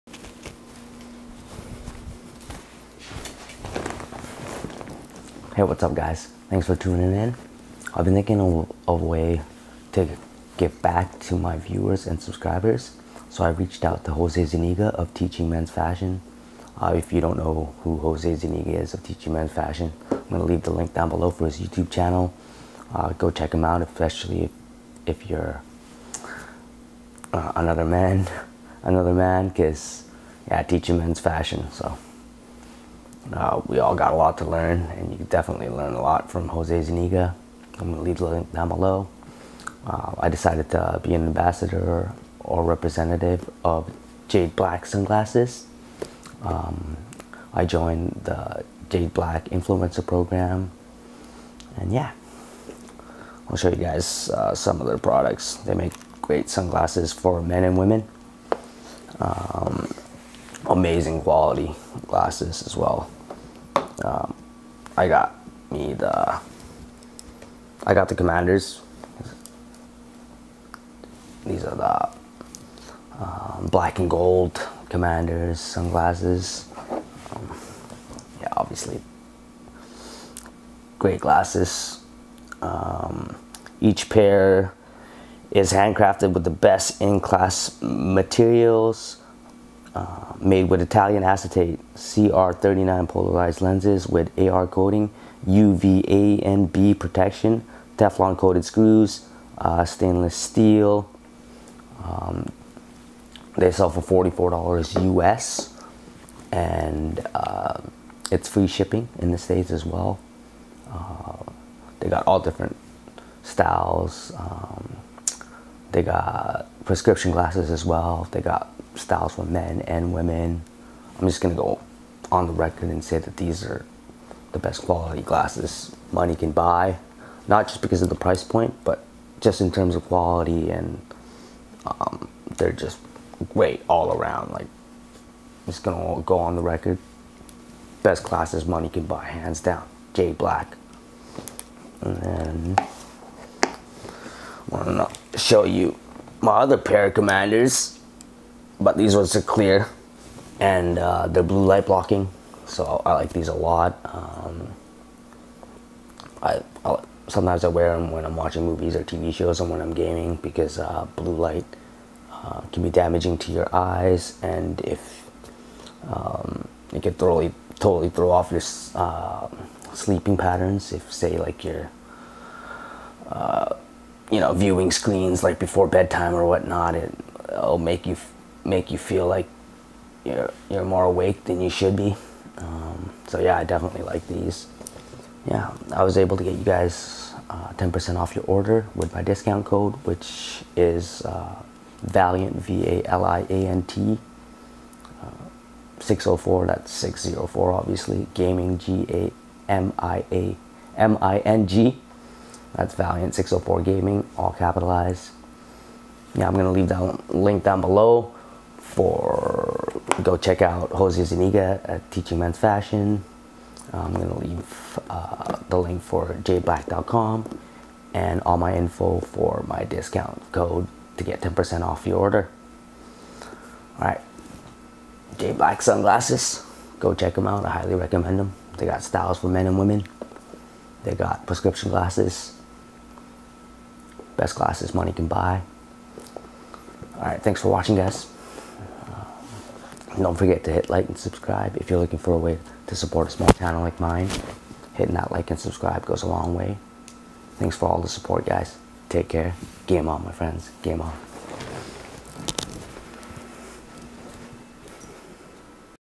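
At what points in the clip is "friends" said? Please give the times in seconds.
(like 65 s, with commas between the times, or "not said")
250 s.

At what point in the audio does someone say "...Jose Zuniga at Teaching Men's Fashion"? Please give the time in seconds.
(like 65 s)
210 s.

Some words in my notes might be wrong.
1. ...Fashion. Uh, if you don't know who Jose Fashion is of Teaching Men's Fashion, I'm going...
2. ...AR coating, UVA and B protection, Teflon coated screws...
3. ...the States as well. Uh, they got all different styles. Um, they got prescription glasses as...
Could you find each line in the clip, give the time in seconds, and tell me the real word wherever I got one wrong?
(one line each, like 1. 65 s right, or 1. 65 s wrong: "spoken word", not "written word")
1. 15 s wrong: "Zuniga", not "Fashion"
2. 94 s right
3. 109 s right.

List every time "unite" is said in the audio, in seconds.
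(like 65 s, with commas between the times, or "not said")
not said.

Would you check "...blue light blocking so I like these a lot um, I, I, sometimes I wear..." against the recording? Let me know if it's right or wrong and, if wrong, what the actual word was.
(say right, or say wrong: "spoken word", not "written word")
right.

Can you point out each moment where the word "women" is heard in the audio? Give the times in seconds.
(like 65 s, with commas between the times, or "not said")
57 s, 120 s, 229 s.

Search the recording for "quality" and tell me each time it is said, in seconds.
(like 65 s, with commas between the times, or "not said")
61 s, 124 s, 130 s.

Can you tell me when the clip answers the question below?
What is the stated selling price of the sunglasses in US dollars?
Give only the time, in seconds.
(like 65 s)
104 s.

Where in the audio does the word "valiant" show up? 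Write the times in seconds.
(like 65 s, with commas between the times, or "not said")
192 s, 202 s.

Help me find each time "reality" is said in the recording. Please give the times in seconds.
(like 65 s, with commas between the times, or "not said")
not said.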